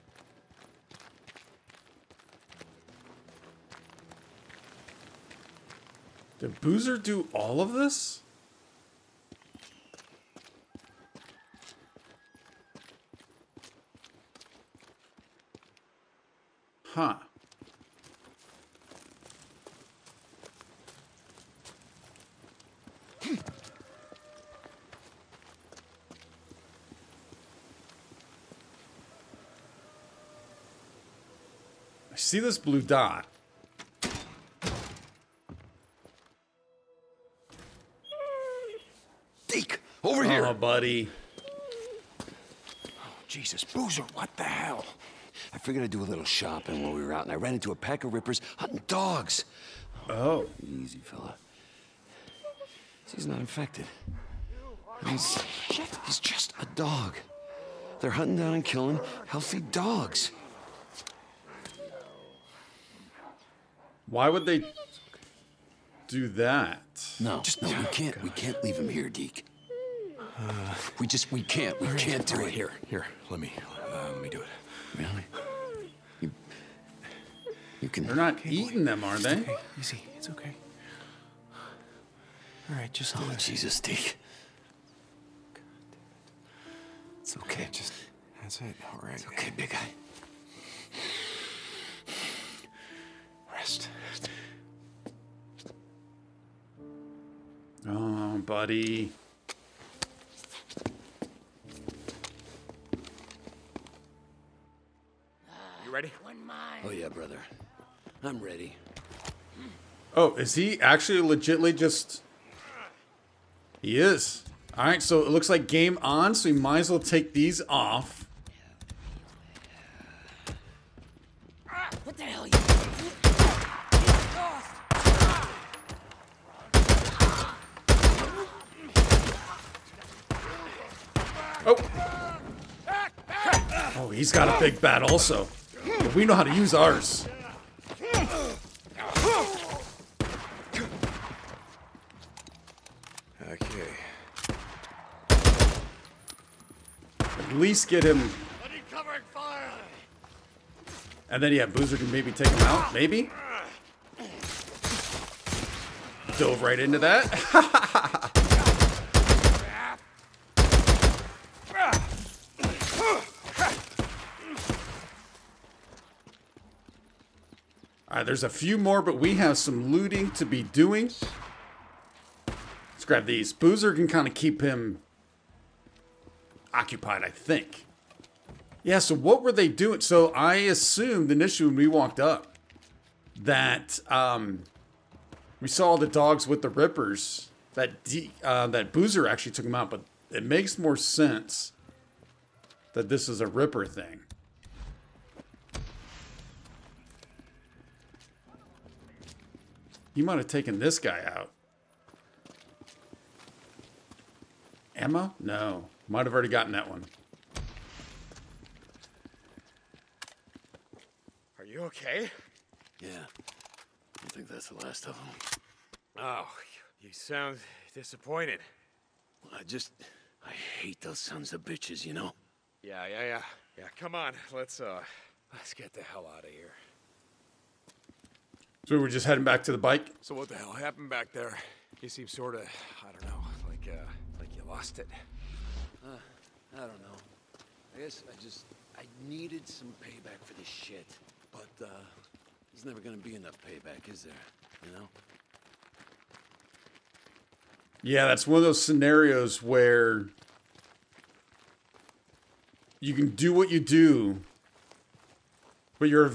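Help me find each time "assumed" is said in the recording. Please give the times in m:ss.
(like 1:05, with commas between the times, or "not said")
3:00.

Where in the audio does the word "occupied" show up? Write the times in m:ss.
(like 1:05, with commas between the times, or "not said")
2:56.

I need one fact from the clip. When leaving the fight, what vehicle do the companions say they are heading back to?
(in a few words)
The bike.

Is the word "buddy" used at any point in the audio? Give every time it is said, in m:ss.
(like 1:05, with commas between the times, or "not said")
0:40, 1:38.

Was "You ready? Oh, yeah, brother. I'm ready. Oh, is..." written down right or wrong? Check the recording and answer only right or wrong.
right.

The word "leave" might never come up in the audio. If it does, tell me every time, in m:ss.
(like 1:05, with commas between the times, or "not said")
1:08.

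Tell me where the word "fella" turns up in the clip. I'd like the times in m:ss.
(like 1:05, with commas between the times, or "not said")
0:51.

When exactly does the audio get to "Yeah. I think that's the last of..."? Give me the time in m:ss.
3:32.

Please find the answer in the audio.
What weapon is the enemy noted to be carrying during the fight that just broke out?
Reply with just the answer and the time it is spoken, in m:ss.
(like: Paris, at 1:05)
A big bat, at 2:14.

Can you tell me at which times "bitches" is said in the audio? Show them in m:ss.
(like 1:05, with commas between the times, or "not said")
3:41.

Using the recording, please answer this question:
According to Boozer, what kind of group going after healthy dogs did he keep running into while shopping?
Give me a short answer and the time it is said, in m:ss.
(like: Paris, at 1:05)
A pack of rippers, at 0:47.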